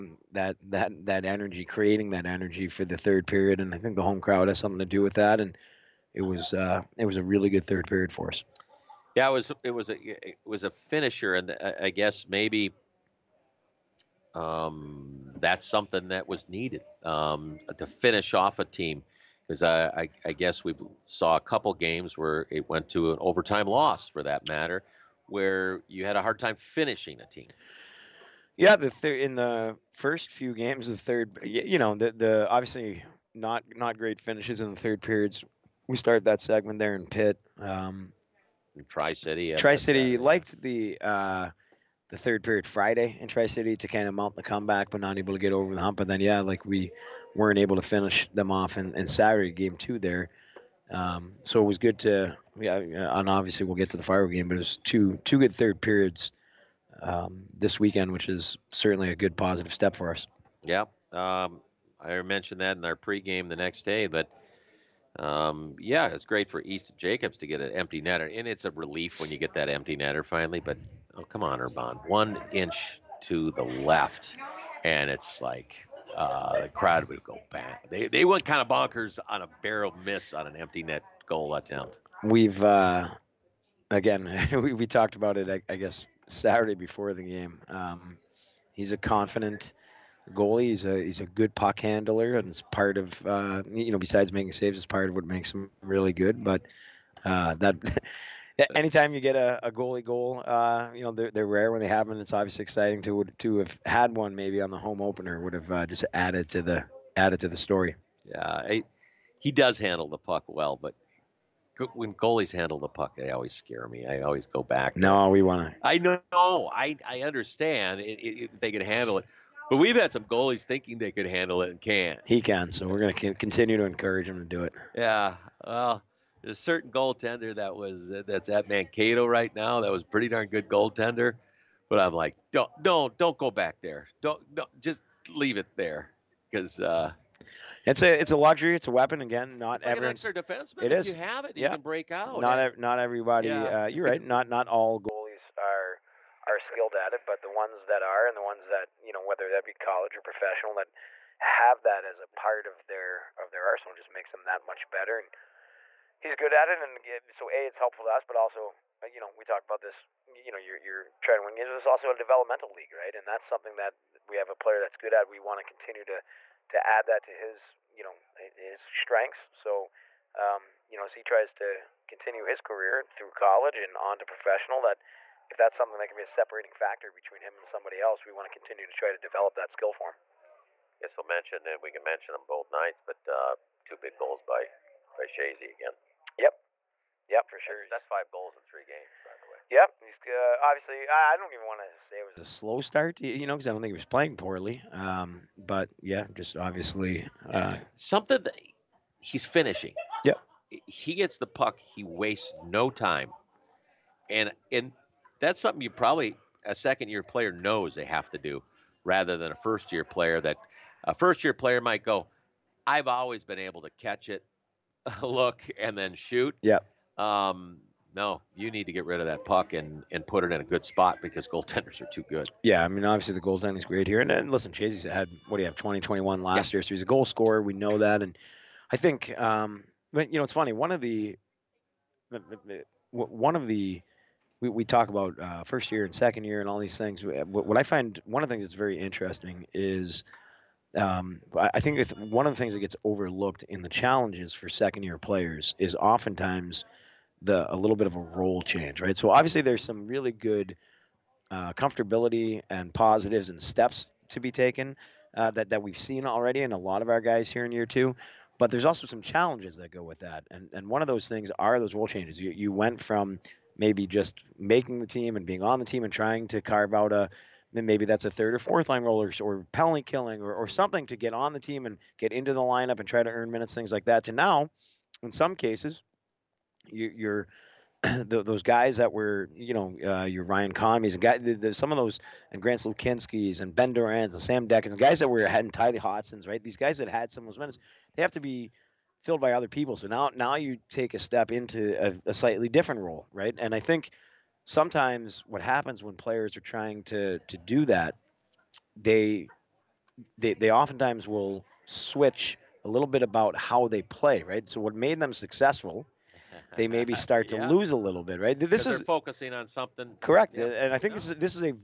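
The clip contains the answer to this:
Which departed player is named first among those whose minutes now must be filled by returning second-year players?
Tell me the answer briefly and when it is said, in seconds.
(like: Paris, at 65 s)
Ryan Conmies, at 280 s.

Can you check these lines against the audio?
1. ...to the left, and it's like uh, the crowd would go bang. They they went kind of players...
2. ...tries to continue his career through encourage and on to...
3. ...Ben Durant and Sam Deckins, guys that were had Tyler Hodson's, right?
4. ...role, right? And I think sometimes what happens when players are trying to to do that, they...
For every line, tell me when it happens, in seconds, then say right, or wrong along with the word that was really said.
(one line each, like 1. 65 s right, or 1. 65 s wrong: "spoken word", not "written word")
1. 73 s wrong: "bonkers", not "players"
2. 171 s wrong: "college", not "encourage"
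3. 283 s right
4. 293 s right.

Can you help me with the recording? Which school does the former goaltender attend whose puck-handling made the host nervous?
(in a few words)
Mankato.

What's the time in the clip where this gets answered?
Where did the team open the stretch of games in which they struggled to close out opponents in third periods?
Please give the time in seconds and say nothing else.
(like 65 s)
37 s.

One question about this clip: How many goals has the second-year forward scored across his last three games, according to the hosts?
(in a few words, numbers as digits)
5.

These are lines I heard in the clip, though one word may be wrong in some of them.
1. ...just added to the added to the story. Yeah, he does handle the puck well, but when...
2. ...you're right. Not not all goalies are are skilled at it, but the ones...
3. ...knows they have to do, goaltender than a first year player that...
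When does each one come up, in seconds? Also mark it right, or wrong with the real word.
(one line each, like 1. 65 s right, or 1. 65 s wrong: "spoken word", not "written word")
1. 105 s right
2. 143 s right
3. 207 s wrong: "rather", not "goaltender".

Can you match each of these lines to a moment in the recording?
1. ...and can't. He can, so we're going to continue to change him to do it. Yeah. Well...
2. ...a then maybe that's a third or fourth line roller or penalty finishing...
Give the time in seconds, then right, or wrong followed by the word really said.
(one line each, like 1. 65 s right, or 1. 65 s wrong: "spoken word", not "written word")
1. 121 s wrong: "encourage", not "change"
2. 267 s wrong: "killing", not "finishing".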